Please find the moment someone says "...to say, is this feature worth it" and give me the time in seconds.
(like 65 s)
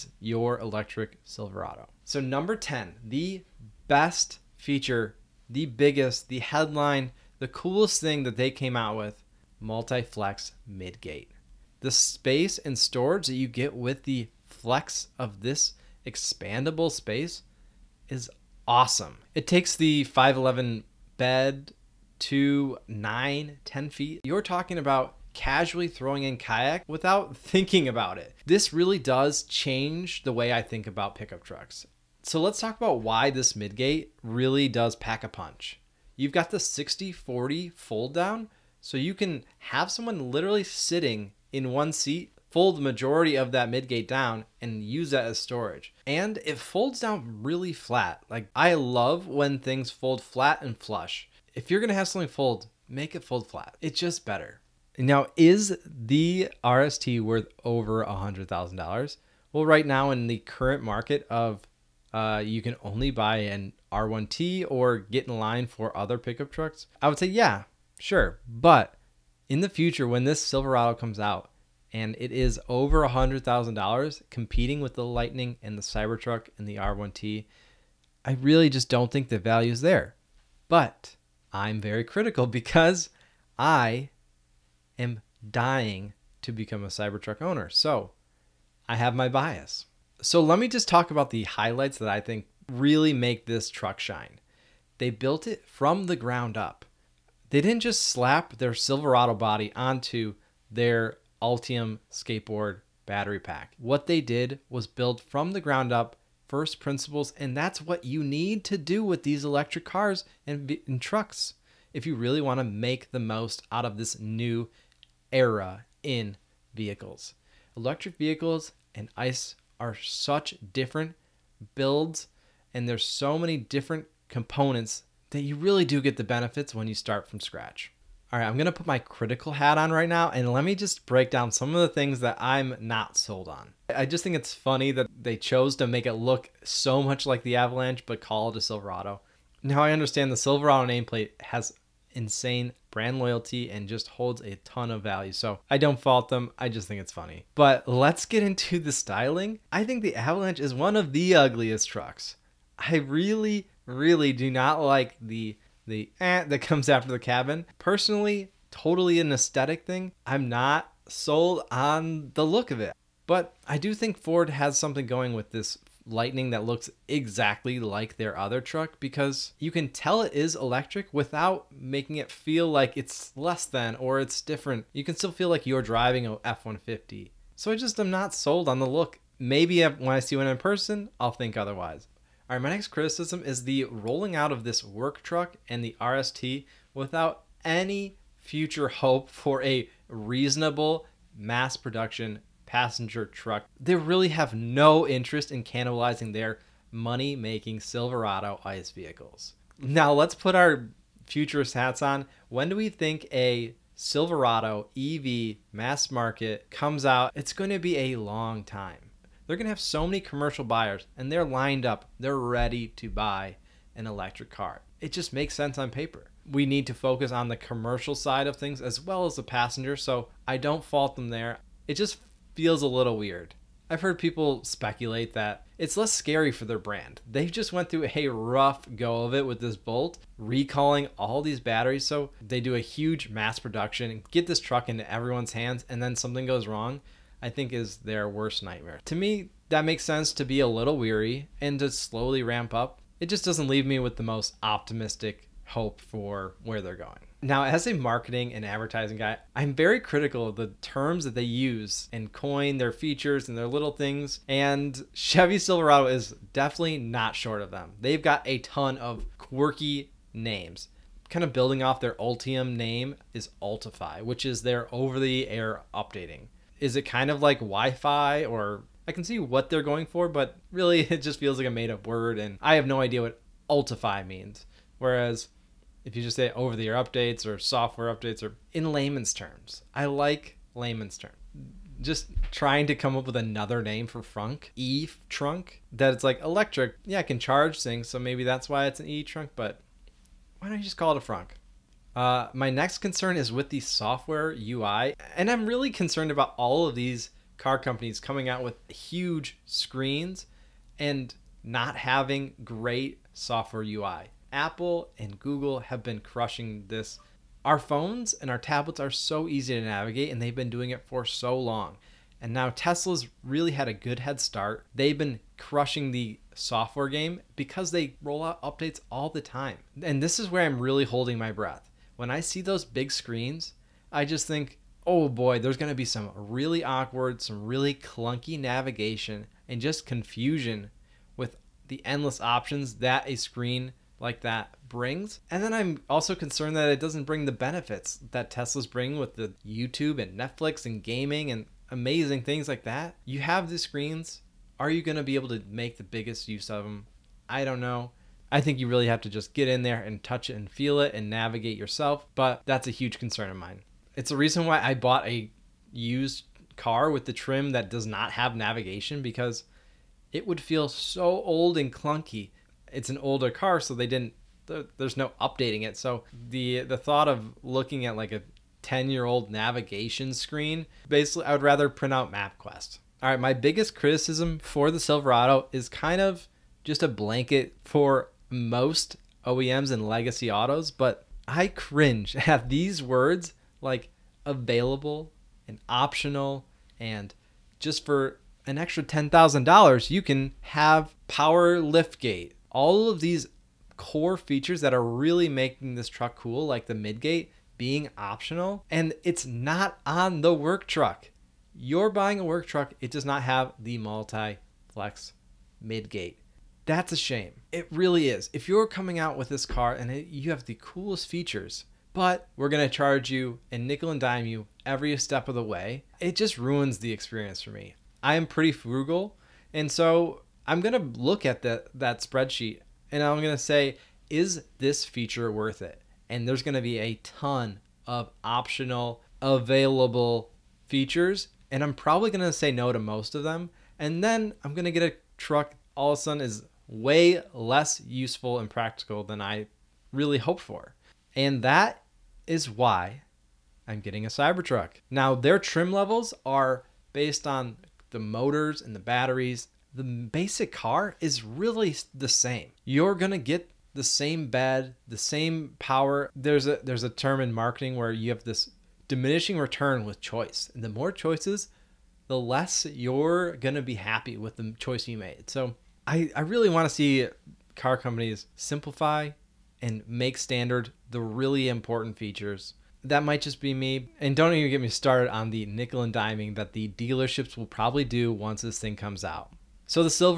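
423 s.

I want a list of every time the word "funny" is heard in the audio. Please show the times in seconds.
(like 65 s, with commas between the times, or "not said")
134 s, 147 s.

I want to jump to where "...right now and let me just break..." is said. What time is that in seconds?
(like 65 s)
129 s.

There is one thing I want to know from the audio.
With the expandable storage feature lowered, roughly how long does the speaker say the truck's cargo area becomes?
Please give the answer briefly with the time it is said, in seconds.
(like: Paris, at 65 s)
9 to 10 feet, at 22 s.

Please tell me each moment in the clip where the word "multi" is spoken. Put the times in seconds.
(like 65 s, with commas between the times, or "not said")
9 s, 403 s.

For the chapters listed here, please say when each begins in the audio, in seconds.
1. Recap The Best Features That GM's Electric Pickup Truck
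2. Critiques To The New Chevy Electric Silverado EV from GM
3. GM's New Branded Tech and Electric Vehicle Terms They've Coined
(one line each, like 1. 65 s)
1. 56 s
2. 131 s
3. 246 s.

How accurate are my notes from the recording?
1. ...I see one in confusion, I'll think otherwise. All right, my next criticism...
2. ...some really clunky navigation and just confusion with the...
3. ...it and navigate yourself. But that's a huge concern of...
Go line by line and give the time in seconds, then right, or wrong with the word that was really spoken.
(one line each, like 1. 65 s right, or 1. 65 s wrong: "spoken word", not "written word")
1. 180 s wrong: "person", not "confusion"
2. 327 s right
3. 350 s right.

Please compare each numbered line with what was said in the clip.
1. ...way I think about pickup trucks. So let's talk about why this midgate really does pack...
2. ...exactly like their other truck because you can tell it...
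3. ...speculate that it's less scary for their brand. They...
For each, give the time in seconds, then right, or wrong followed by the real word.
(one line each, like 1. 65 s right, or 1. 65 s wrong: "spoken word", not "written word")
1. 30 s right
2. 167 s right
3. 224 s right.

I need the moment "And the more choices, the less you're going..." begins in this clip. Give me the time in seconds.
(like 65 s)
460 s.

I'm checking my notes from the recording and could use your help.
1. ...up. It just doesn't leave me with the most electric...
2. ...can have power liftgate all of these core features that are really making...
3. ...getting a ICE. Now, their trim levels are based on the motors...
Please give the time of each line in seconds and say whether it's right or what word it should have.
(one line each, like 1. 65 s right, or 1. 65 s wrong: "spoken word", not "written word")
1. 242 s wrong: "optimistic", not "electric"
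2. 390 s right
3. 443 s wrong: "Cybertruck", not "ICE".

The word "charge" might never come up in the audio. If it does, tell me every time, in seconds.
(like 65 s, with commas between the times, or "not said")
287 s, 412 s.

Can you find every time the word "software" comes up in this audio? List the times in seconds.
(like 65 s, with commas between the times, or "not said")
277 s, 293 s, 303 s, 316 s.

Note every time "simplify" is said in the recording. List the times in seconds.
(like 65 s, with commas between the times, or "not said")
468 s.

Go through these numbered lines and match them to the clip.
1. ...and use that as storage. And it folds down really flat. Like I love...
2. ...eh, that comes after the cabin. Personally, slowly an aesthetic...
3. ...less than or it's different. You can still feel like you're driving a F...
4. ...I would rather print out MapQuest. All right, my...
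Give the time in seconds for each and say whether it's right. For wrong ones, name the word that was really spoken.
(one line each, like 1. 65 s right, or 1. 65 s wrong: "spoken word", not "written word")
1. 44 s right
2. 156 s wrong: "totally", not "slowly"
3. 173 s right
4. 371 s right.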